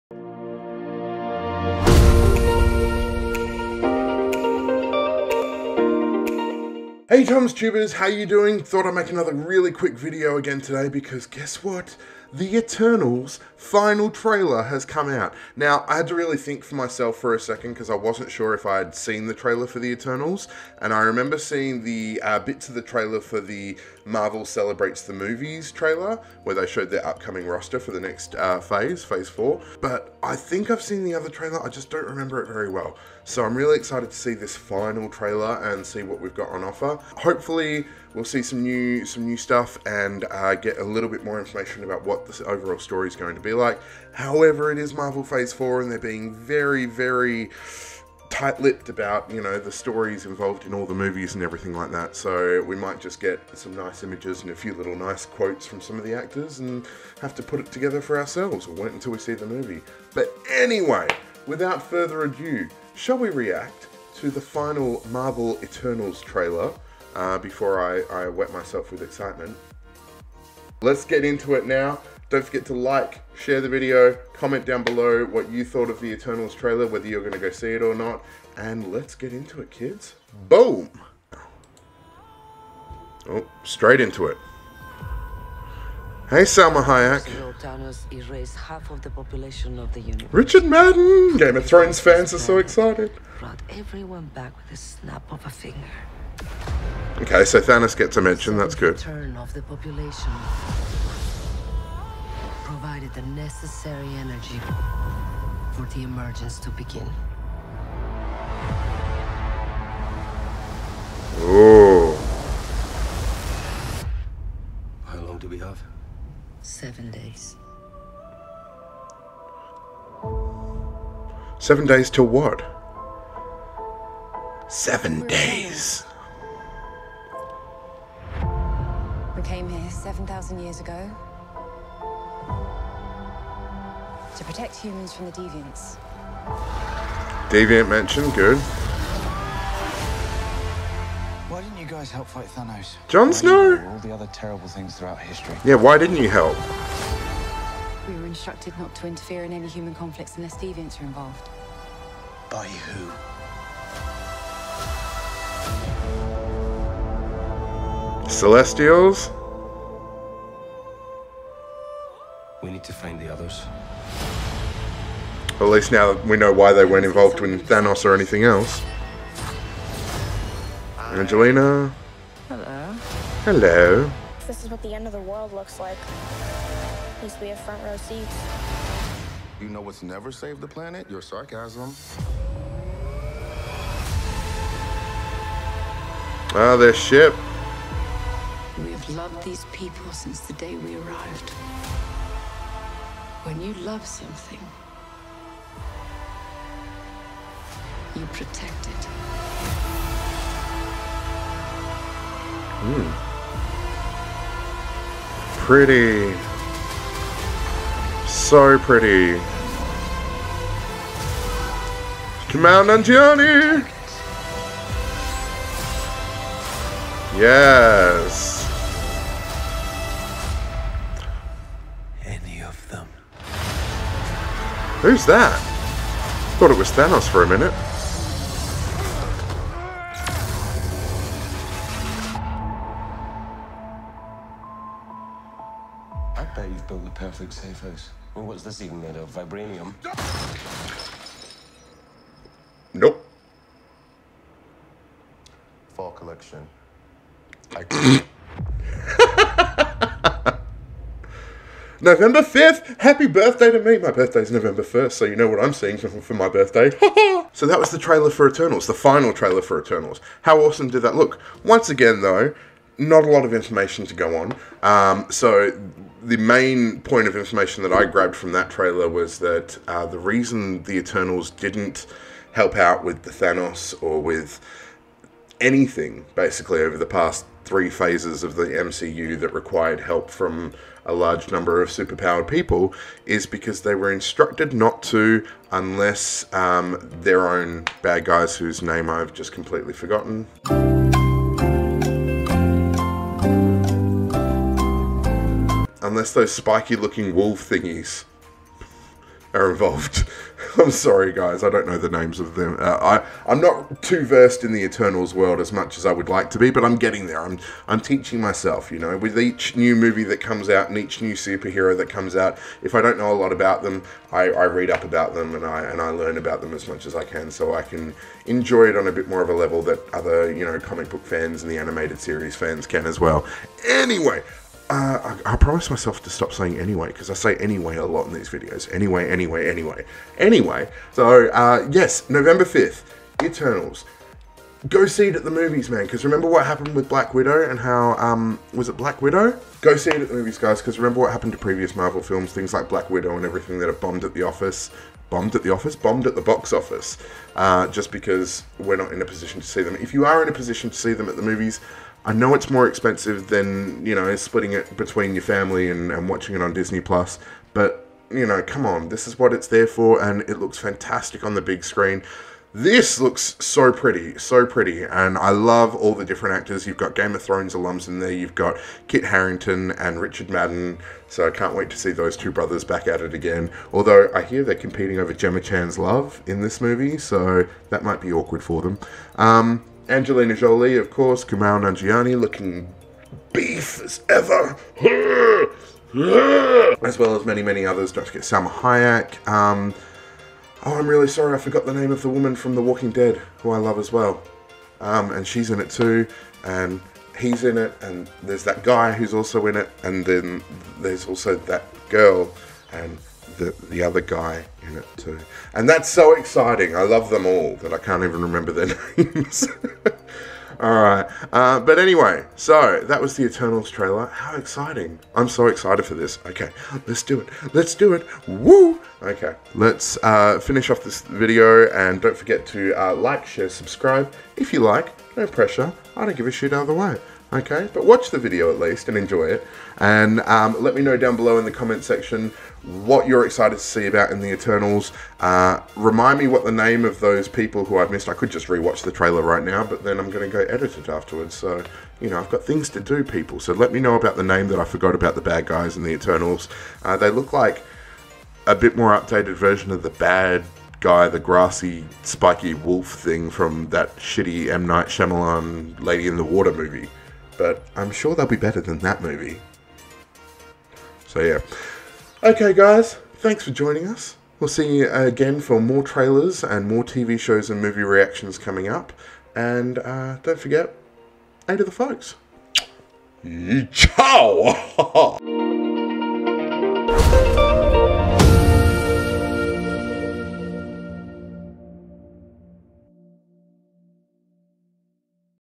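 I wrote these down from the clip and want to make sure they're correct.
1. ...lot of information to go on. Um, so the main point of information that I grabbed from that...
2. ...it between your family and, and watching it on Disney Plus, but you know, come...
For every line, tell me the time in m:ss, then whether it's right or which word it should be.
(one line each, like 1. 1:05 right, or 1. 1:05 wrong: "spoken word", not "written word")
1. 4:23 right
2. 5:54 right.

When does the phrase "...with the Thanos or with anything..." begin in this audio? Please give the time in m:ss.
4:33.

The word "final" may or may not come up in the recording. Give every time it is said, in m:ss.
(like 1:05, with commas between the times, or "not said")
0:13, 0:34, 1:04, 4:18.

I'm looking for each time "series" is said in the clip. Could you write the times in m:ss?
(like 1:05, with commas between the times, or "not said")
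5:22.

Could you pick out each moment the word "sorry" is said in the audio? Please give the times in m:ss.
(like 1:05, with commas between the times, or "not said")
5:00, 6:31.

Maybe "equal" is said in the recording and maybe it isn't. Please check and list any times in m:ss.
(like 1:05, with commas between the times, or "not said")
not said.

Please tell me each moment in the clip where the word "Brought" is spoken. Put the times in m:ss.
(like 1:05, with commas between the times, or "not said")
1:33.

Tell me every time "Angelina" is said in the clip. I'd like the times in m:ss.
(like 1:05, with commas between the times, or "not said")
2:50, 6:20.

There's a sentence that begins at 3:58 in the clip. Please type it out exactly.
Well, what's this even made of?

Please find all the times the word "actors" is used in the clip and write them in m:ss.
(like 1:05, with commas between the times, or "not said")
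0:56, 6:06.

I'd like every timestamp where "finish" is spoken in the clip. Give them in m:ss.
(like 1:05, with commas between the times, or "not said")
7:00.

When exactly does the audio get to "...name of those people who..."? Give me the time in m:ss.
7:16.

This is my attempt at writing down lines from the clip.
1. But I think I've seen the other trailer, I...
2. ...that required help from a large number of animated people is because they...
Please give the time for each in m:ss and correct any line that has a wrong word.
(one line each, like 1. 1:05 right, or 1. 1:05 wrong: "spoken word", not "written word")
1. 0:29 right
2. 4:39 wrong: "superpowered", not "animated".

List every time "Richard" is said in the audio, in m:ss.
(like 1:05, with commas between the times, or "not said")
1:30, 6:10.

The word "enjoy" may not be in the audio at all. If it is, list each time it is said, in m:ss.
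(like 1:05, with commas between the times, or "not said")
5:18, 7:09.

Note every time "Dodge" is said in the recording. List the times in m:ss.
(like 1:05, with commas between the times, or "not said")
not said.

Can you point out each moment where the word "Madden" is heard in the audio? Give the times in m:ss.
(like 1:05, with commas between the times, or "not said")
1:30, 6:10.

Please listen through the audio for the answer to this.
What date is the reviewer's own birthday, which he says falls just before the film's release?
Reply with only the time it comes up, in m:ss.
4:14.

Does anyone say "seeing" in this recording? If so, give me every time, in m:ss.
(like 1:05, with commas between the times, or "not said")
0:21, 4:15.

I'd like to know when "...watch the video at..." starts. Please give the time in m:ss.
7:08.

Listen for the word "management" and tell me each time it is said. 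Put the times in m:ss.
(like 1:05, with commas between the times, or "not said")
not said.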